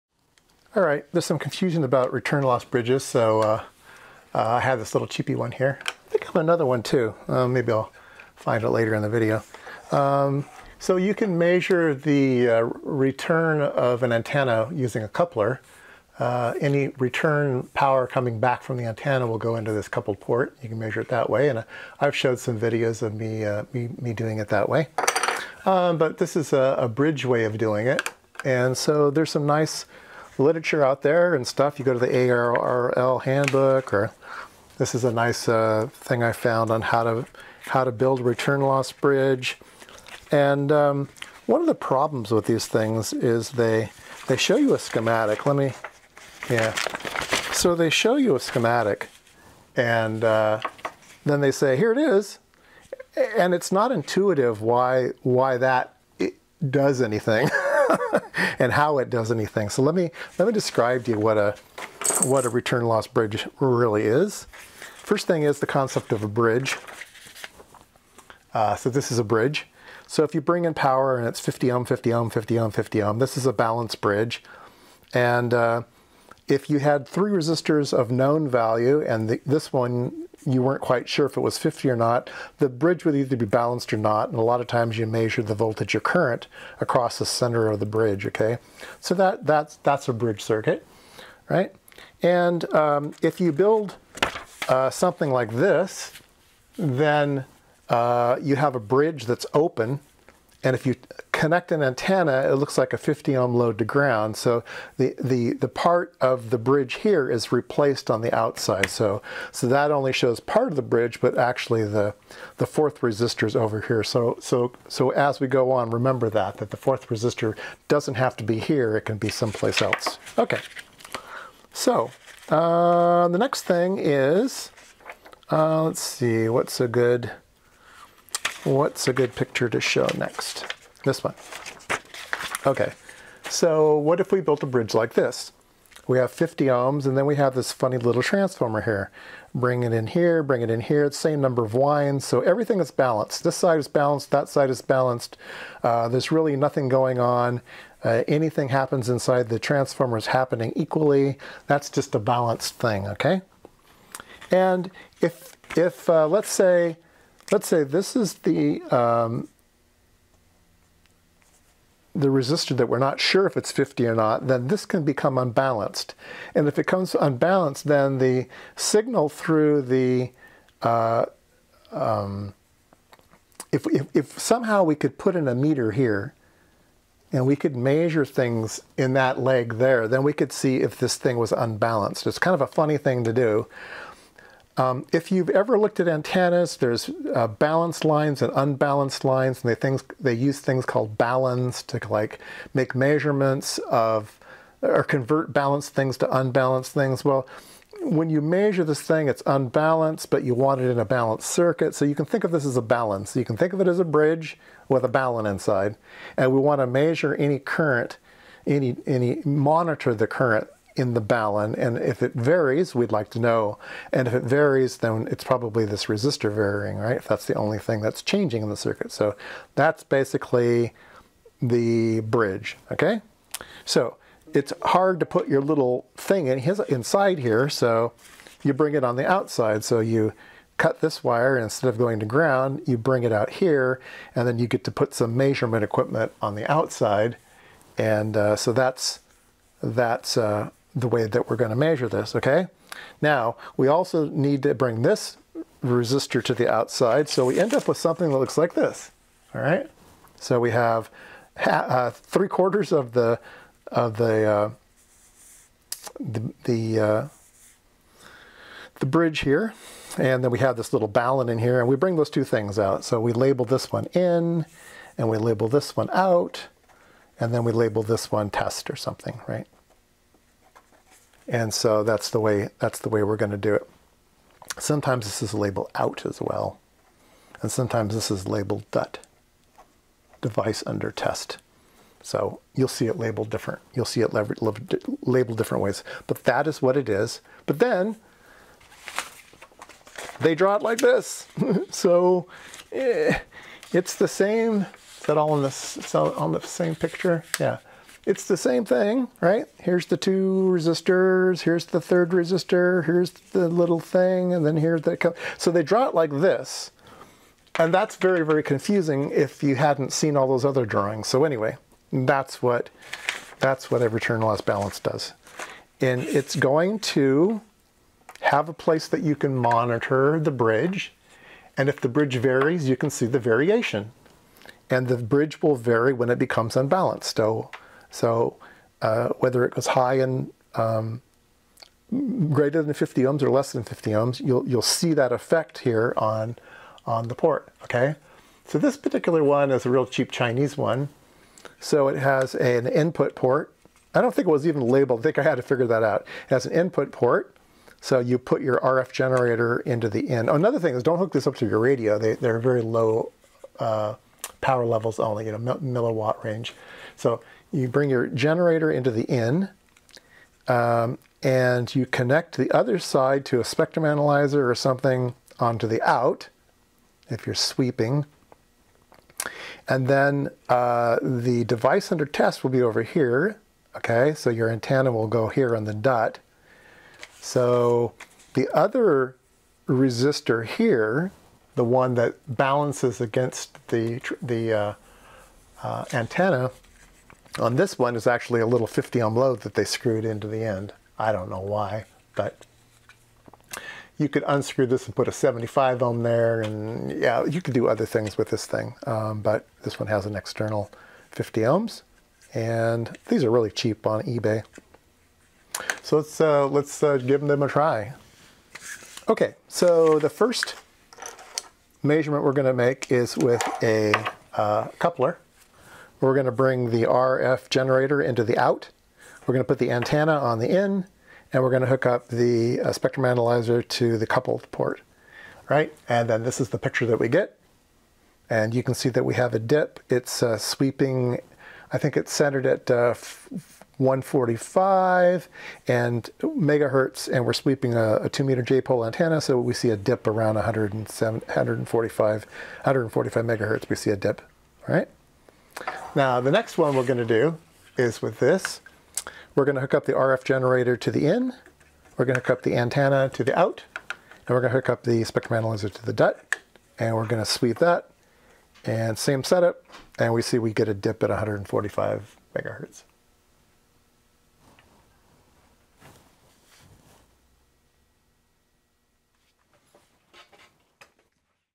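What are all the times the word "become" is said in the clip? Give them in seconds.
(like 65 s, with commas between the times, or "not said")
165 s, 326 s.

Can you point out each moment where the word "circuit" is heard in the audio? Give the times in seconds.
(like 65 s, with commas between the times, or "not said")
90 s, 201 s, 218 s.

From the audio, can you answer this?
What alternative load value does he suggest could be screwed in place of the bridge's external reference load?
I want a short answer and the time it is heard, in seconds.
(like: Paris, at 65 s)
75 ohms, at 395 s.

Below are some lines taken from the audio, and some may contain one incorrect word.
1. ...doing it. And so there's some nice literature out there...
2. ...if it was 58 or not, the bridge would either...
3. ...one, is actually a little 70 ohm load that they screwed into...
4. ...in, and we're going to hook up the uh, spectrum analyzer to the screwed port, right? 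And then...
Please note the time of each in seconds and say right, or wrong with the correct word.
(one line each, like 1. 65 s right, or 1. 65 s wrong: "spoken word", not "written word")
1. 27 s right
2. 81 s wrong: "50", not "58"
3. 387 s wrong: "50", not "70"
4. 420 s wrong: "coupled", not "screwed".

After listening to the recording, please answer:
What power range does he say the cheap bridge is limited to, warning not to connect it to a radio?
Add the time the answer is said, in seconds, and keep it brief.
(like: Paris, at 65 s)
Milliwatt range, at 355 s.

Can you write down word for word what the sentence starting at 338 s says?
So this particular one is a real cheap Chinese one.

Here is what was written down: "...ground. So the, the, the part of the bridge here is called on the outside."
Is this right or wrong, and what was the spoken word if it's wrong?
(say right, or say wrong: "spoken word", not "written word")
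wrong: "replaced", not "called".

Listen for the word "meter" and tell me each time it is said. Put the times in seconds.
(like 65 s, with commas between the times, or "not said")
175 s, 438 s.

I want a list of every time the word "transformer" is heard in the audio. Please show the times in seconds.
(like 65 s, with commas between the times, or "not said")
138 s, 149 s.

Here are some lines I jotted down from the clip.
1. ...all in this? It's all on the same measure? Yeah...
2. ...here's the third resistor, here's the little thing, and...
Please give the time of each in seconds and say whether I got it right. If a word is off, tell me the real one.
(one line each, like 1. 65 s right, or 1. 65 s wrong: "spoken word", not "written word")
1. 295 s wrong: "picture", not "measure"
2. 301 s right.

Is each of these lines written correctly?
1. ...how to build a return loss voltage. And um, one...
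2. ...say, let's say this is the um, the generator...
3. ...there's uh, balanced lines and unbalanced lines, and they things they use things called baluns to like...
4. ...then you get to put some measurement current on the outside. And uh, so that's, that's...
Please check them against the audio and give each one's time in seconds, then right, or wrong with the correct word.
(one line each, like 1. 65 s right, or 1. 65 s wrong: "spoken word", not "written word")
1. 37 s wrong: "bridge", not "voltage"
2. 156 s wrong: "resistor", not "generator"
3. 186 s right
4. 234 s wrong: "equipment", not "current".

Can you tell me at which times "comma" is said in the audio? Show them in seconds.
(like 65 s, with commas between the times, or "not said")
not said.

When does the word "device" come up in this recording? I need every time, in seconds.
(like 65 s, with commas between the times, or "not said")
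280 s, 371 s.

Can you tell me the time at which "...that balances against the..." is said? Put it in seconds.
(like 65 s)
382 s.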